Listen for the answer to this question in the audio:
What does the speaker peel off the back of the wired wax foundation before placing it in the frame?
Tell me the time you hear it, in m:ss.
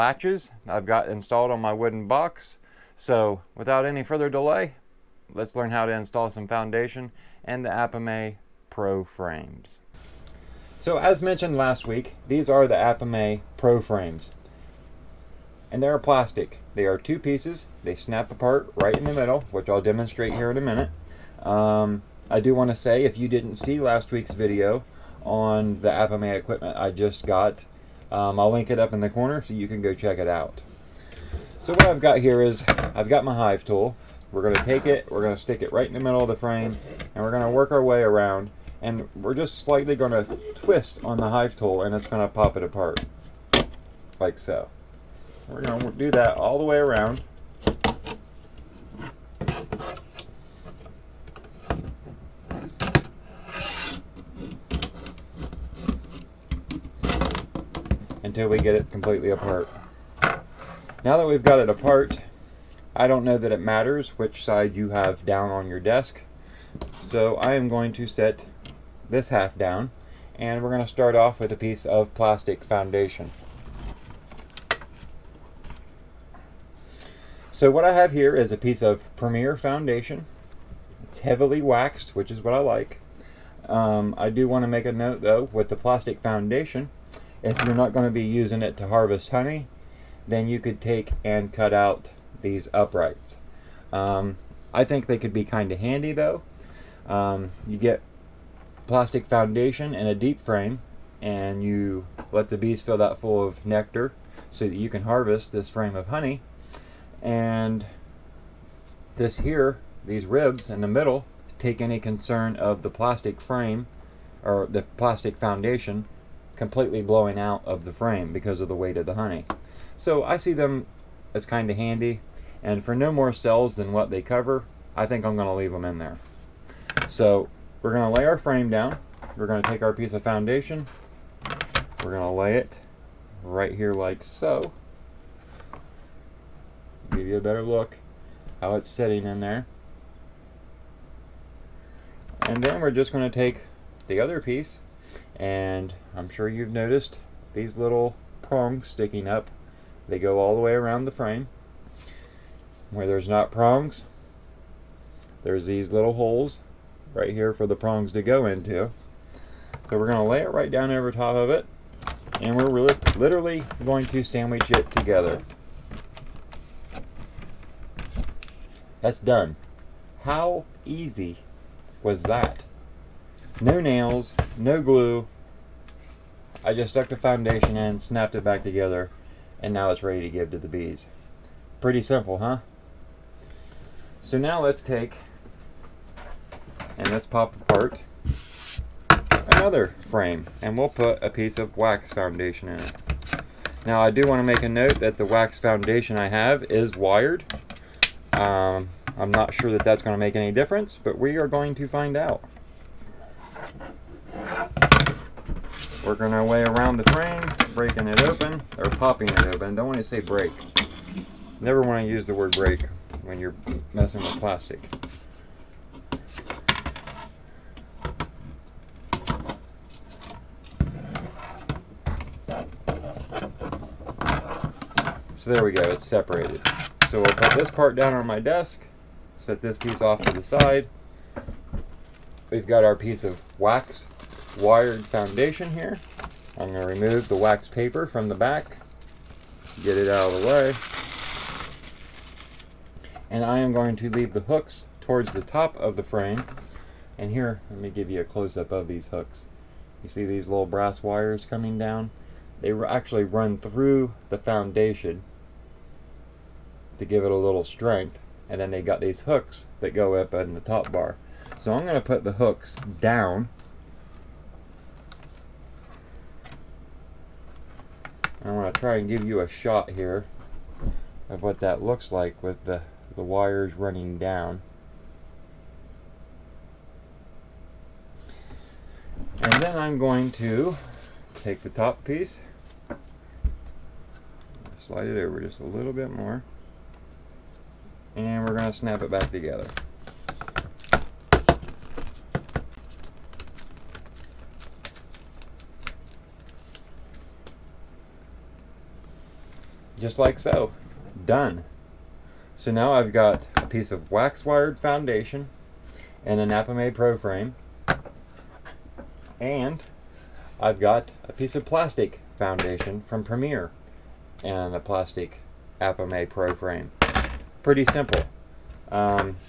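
3:57.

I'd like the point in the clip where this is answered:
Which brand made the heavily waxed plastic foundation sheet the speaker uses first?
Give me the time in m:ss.
1:19.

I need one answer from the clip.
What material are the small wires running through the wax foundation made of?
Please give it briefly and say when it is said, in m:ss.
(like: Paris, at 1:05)
brass, at 4:10.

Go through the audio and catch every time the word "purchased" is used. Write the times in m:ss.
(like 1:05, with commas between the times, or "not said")
not said.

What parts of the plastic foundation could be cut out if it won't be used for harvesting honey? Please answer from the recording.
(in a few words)
uprights.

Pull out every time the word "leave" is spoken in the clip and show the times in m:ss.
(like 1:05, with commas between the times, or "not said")
2:05, 4:04.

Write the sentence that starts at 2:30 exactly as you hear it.
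They go all the way around the frame.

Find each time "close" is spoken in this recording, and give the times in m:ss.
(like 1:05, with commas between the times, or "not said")
4:08.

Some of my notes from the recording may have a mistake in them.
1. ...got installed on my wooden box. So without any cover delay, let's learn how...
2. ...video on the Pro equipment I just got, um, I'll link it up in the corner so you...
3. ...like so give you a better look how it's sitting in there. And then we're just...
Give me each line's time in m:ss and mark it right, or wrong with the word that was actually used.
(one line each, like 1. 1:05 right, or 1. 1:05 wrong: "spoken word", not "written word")
1. 0:00 wrong: "further", not "cover"
2. 0:24 wrong: "Apimaye", not "Pro"
3. 2:13 right.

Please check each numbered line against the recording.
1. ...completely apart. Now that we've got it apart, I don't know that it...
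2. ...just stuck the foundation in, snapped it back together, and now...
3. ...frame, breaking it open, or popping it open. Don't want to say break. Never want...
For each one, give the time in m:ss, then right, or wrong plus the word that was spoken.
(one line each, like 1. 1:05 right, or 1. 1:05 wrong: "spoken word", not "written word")
1. 0:58 right
2. 2:56 right
3. 3:27 right.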